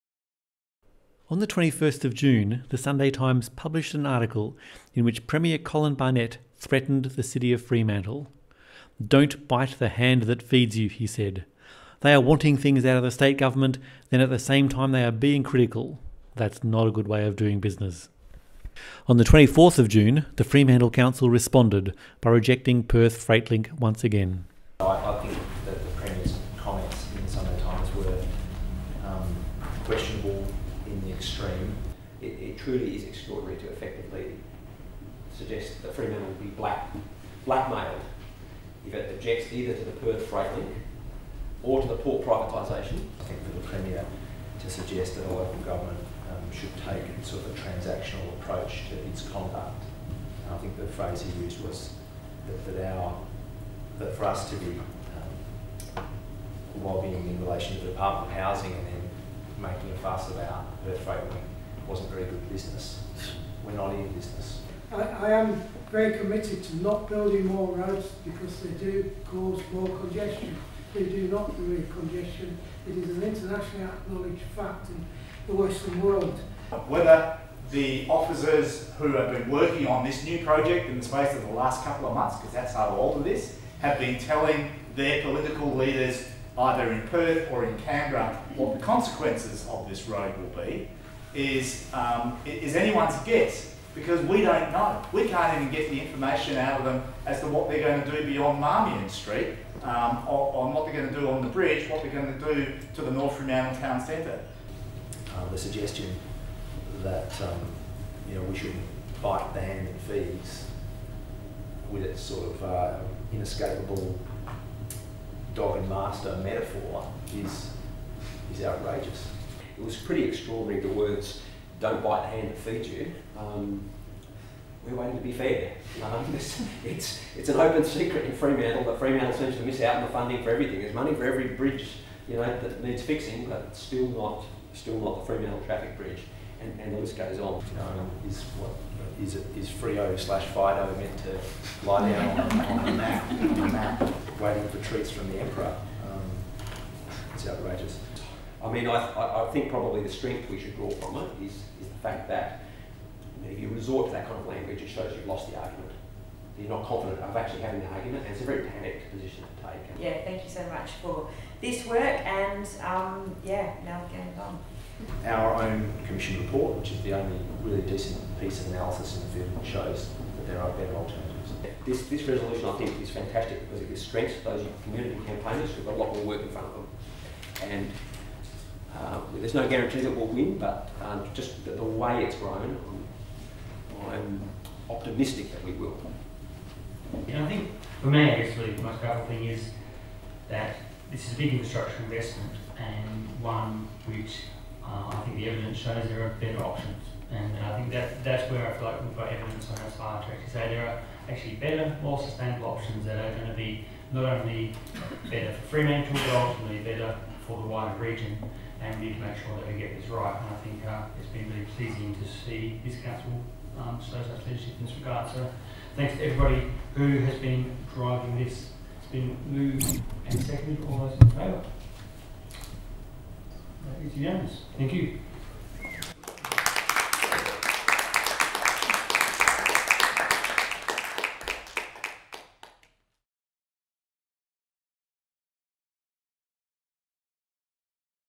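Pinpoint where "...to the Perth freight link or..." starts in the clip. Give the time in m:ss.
0:39.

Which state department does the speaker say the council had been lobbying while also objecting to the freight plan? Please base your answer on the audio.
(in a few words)
Department of Housing.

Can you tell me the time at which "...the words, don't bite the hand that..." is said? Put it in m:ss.
2:00.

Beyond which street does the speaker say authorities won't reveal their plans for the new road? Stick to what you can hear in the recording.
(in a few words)
Marmion Street.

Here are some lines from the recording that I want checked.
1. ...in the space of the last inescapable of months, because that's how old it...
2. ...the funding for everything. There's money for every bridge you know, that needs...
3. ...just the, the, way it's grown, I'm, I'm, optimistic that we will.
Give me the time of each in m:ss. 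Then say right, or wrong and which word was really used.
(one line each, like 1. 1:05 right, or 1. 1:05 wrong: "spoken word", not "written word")
1. 1:20 wrong: "couple", not "inescapable"
2. 2:10 right
3. 3:01 right.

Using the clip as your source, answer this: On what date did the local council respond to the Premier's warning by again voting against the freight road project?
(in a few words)
24 June.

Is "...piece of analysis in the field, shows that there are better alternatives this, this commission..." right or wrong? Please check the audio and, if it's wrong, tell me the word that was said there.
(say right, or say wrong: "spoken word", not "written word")
wrong: "resolution", not "commission".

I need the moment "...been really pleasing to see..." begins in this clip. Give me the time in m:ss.
3:31.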